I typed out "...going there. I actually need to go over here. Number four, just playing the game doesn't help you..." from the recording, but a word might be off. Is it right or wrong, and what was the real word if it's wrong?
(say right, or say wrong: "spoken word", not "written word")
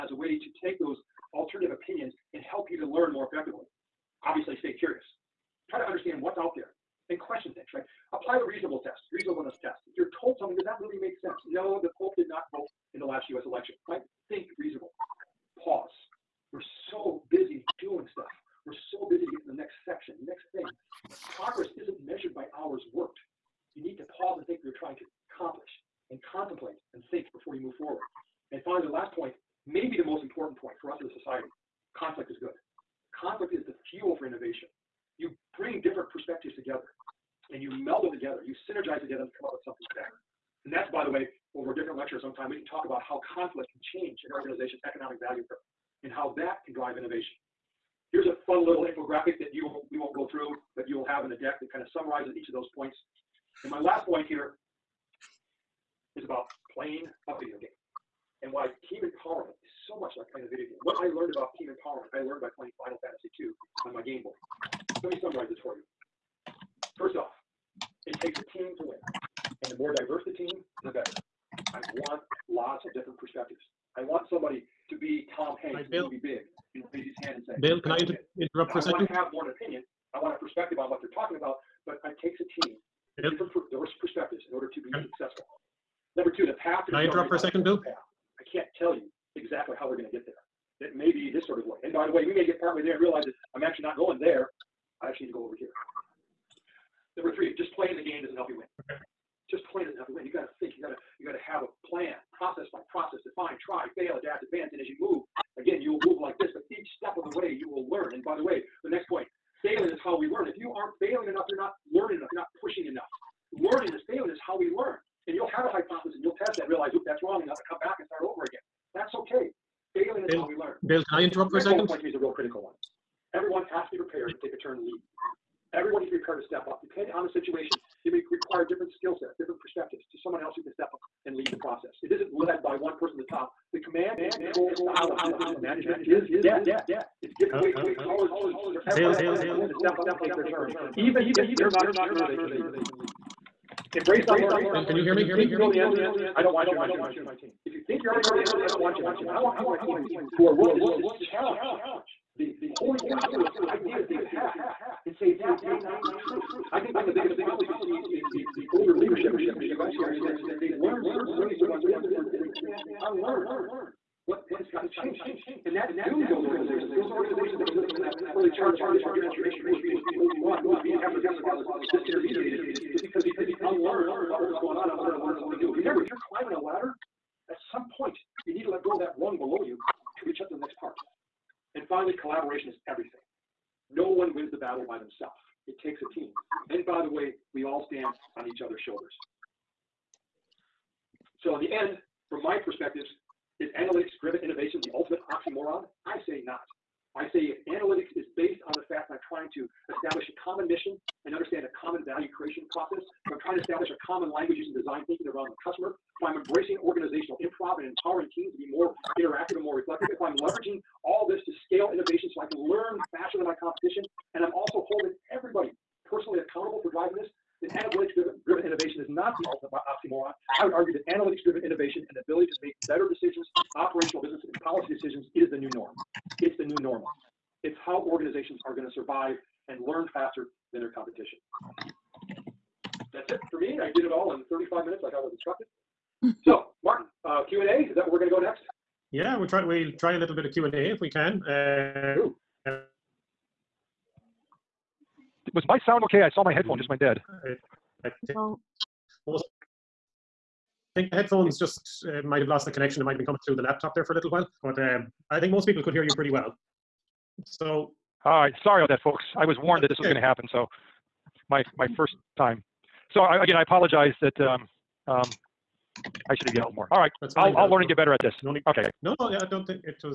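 wrong: "three", not "four".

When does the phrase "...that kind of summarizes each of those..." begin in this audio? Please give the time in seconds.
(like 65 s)
51 s.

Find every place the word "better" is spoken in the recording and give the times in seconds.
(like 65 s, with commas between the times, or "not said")
39 s, 70 s, 267 s.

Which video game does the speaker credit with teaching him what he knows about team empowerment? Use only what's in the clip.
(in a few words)
Final Fantasy II.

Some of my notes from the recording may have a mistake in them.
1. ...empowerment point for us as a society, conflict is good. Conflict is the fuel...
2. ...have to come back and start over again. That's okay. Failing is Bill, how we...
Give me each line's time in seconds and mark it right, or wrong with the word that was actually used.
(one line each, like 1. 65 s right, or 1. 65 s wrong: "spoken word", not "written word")
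1. 30 s wrong: "important", not "empowerment"
2. 117 s right.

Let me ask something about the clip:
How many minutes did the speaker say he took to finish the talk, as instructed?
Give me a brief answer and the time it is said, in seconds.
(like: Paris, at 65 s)
35, at 234 s.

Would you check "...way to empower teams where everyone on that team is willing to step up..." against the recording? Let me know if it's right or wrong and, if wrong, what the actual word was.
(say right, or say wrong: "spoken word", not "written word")
right.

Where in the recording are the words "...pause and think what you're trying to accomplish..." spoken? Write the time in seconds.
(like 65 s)
24 s.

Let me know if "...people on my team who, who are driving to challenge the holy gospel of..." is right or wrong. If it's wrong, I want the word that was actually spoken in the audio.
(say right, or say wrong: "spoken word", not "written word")
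wrong: "willing", not "driving".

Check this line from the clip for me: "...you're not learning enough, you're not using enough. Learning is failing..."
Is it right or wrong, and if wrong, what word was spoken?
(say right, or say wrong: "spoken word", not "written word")
wrong: "pushing", not "using".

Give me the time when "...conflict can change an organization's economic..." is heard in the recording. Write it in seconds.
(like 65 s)
43 s.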